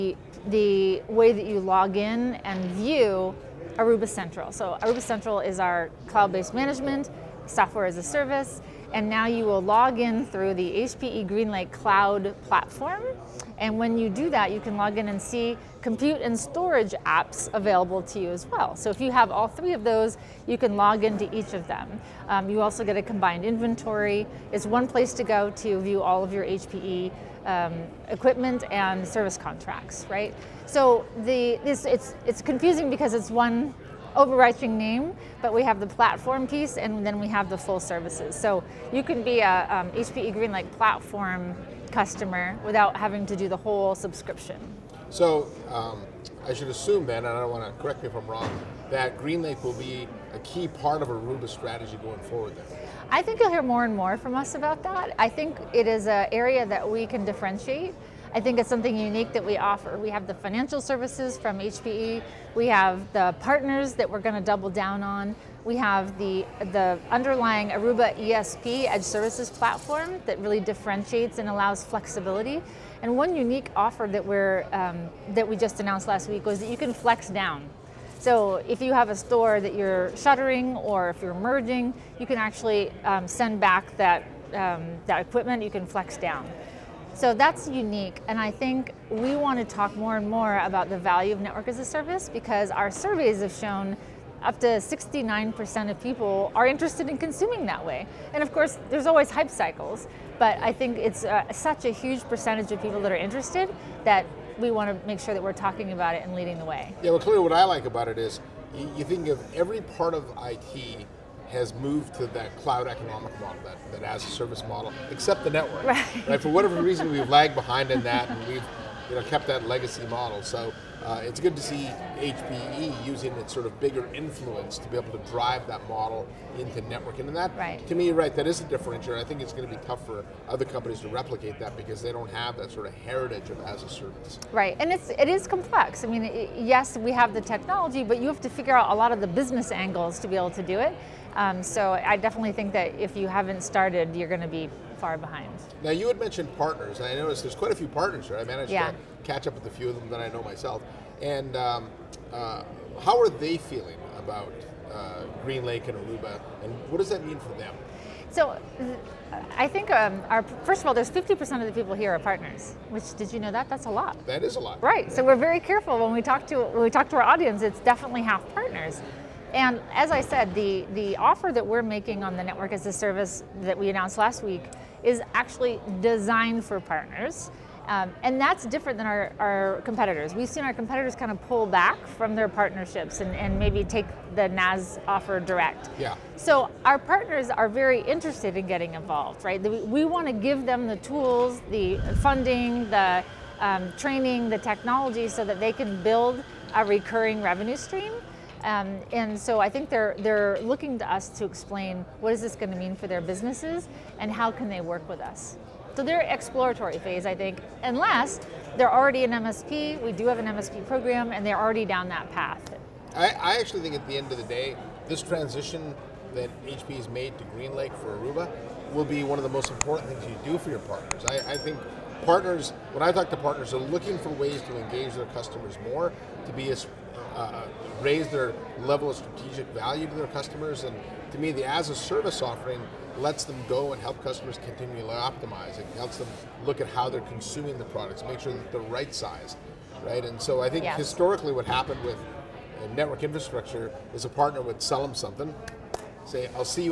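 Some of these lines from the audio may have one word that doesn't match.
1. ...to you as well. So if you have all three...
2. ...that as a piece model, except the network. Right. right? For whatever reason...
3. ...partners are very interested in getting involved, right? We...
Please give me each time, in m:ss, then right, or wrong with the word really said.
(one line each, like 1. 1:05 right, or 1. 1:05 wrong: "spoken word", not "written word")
1. 0:18 right
2. 1:53 wrong: "service", not "piece"
3. 3:06 right.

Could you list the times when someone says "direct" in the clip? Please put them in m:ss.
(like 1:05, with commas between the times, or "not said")
3:05.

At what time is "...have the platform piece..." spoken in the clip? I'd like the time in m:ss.
0:35.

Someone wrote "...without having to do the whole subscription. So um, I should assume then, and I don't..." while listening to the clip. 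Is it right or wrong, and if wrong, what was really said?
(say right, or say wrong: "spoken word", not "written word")
right.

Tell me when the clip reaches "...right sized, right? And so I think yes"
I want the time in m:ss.
3:58.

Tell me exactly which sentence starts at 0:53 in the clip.
I think you'll hear more and more from us about that.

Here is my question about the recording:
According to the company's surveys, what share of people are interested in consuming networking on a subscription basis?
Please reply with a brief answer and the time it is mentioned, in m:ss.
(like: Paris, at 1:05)
69%, at 1:34.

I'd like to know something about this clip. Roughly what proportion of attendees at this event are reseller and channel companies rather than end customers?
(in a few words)
50%.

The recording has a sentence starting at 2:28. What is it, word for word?
to catch up with a few of them that I know myself.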